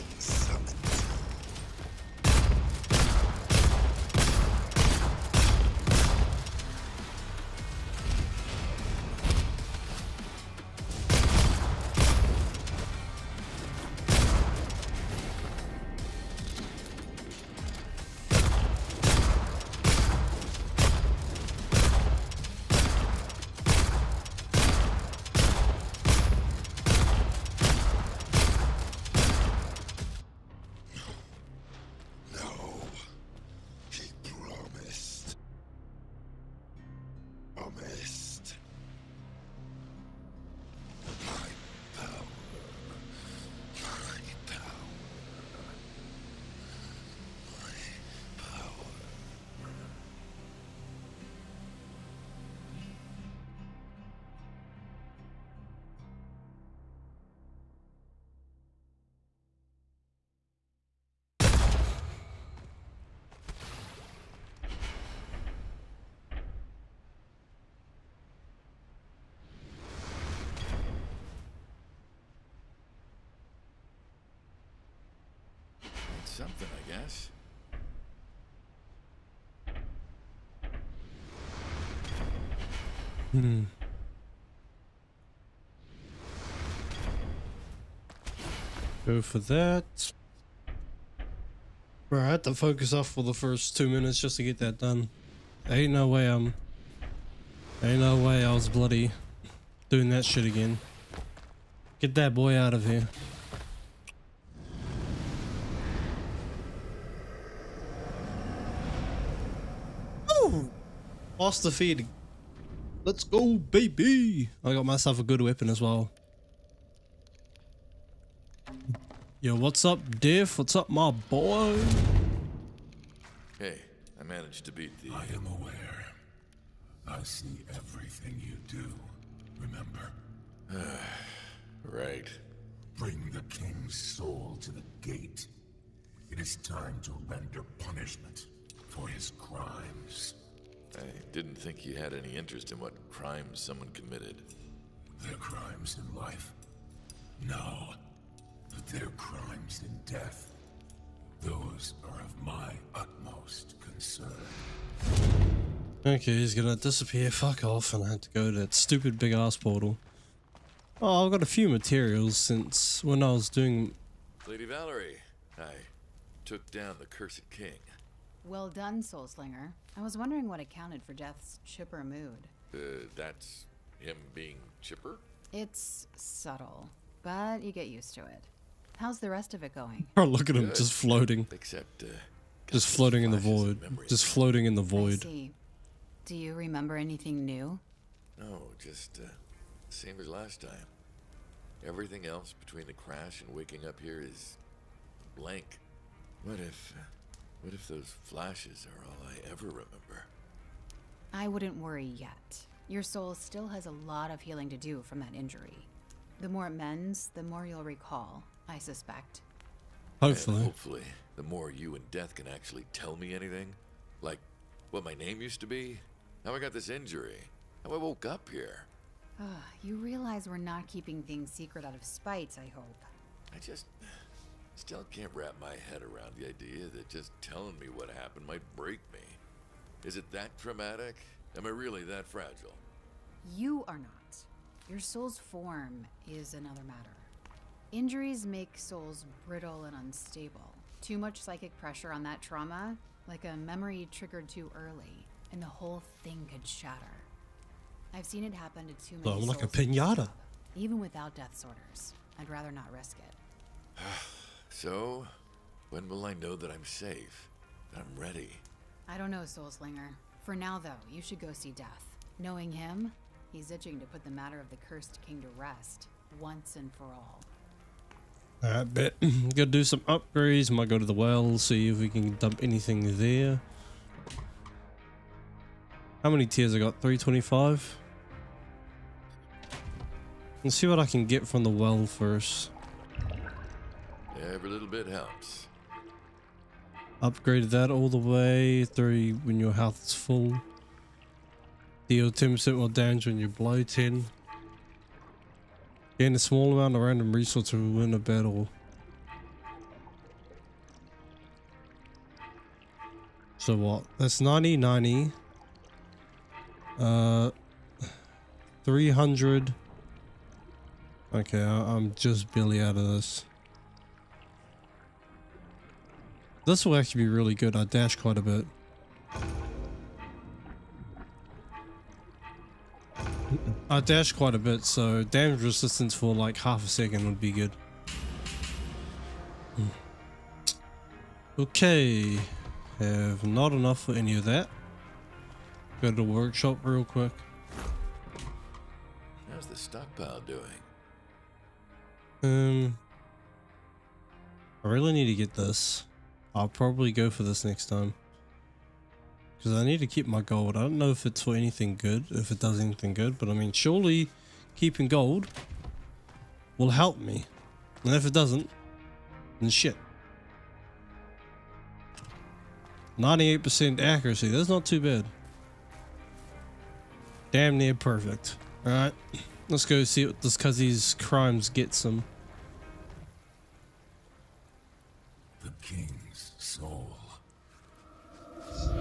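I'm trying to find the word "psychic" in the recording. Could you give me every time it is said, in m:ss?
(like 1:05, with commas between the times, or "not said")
4:01.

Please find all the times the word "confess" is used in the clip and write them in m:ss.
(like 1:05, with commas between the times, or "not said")
not said.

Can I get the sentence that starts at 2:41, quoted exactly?
Oh, I've got a few materials since when I was doing...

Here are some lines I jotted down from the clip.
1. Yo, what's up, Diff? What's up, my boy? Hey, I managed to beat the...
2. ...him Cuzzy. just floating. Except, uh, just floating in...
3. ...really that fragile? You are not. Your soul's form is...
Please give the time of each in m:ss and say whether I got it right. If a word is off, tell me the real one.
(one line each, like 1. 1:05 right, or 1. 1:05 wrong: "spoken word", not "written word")
1. 1:59 right
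2. 3:00 wrong: "Good", not "Cuzzy"
3. 3:51 right.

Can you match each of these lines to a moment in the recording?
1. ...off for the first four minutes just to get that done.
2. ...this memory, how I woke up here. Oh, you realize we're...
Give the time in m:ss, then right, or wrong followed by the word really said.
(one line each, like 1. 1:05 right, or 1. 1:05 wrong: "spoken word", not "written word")
1. 1:32 wrong: "two", not "four"
2. 3:36 wrong: "injury", not "memory".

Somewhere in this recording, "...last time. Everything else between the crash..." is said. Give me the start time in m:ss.
3:10.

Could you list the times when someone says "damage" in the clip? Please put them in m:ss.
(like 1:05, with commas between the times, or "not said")
4:52, 5:25.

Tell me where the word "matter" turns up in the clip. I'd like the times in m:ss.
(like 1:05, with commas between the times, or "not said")
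3:56, 4:24.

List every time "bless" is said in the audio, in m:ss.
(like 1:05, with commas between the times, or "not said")
not said.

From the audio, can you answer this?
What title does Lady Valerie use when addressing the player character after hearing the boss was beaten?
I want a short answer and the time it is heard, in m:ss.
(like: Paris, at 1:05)
Soul Slinger, at 2:49.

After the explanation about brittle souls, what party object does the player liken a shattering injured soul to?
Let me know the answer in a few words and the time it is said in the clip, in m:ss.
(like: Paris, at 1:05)
pinata, at 4:09.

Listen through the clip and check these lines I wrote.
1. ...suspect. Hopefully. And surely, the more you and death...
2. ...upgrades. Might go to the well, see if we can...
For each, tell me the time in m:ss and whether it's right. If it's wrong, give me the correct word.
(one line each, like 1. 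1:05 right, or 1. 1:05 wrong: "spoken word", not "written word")
1. 3:28 wrong: "hopefully", not "surely"
2. 4:30 right.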